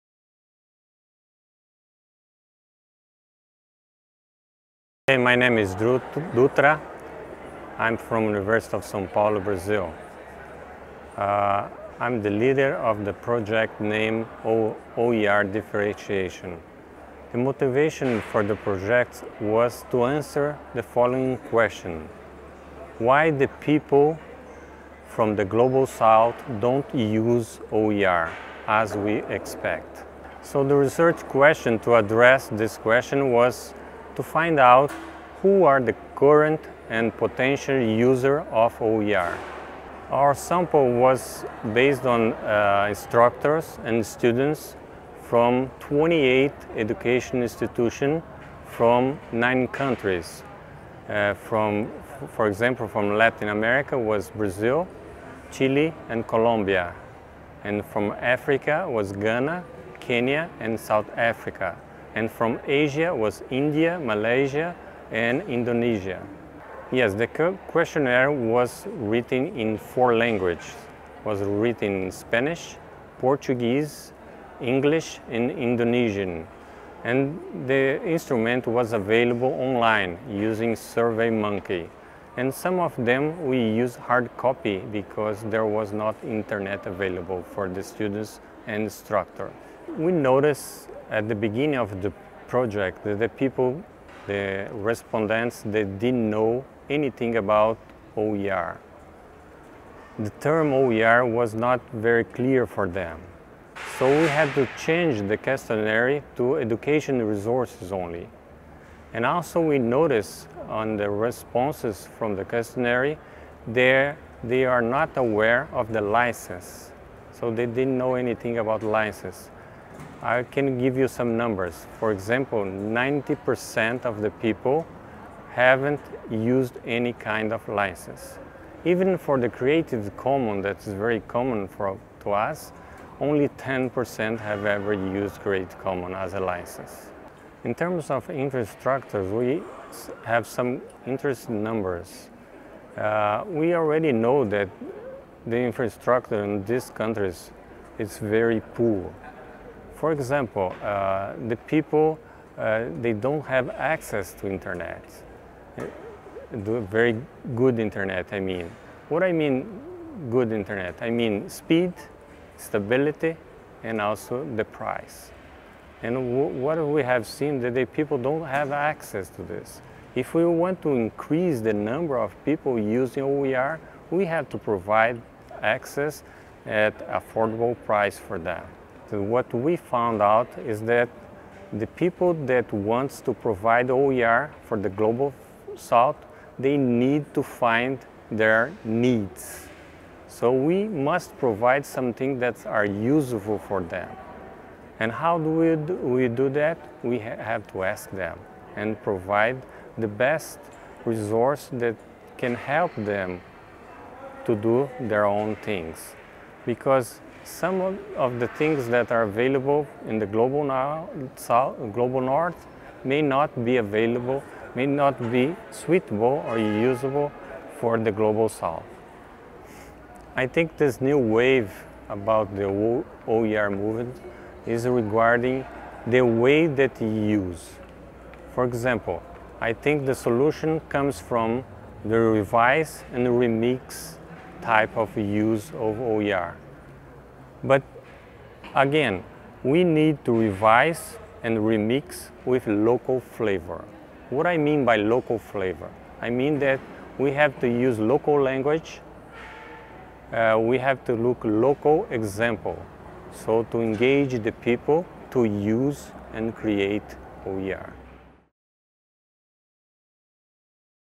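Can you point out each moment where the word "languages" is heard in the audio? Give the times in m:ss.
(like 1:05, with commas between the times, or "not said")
1:10, 4:08.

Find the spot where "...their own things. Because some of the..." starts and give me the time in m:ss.
3:24.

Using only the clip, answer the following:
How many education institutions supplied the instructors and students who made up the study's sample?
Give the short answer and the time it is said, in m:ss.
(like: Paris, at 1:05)
28, at 0:45.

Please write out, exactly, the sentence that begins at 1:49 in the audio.
And also we noticed on the responses from the questionnaire, they are not aware of the license.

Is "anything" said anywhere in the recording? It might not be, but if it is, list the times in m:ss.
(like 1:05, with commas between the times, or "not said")
1:36, 1:58.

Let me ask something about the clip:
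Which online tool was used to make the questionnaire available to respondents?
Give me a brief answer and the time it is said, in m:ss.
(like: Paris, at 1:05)
SurveyMonkey, at 1:20.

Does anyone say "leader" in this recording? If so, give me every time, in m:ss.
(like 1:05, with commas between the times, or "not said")
0:12.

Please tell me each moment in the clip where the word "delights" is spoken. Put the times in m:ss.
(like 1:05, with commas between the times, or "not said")
not said.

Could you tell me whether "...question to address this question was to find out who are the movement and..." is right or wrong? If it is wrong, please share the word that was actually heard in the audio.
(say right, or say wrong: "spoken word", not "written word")
wrong: "current", not "movement".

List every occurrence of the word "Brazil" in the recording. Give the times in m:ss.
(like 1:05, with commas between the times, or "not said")
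0:09, 0:54.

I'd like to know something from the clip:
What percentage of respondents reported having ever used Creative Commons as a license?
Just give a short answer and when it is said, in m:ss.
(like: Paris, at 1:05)
10%, at 2:13.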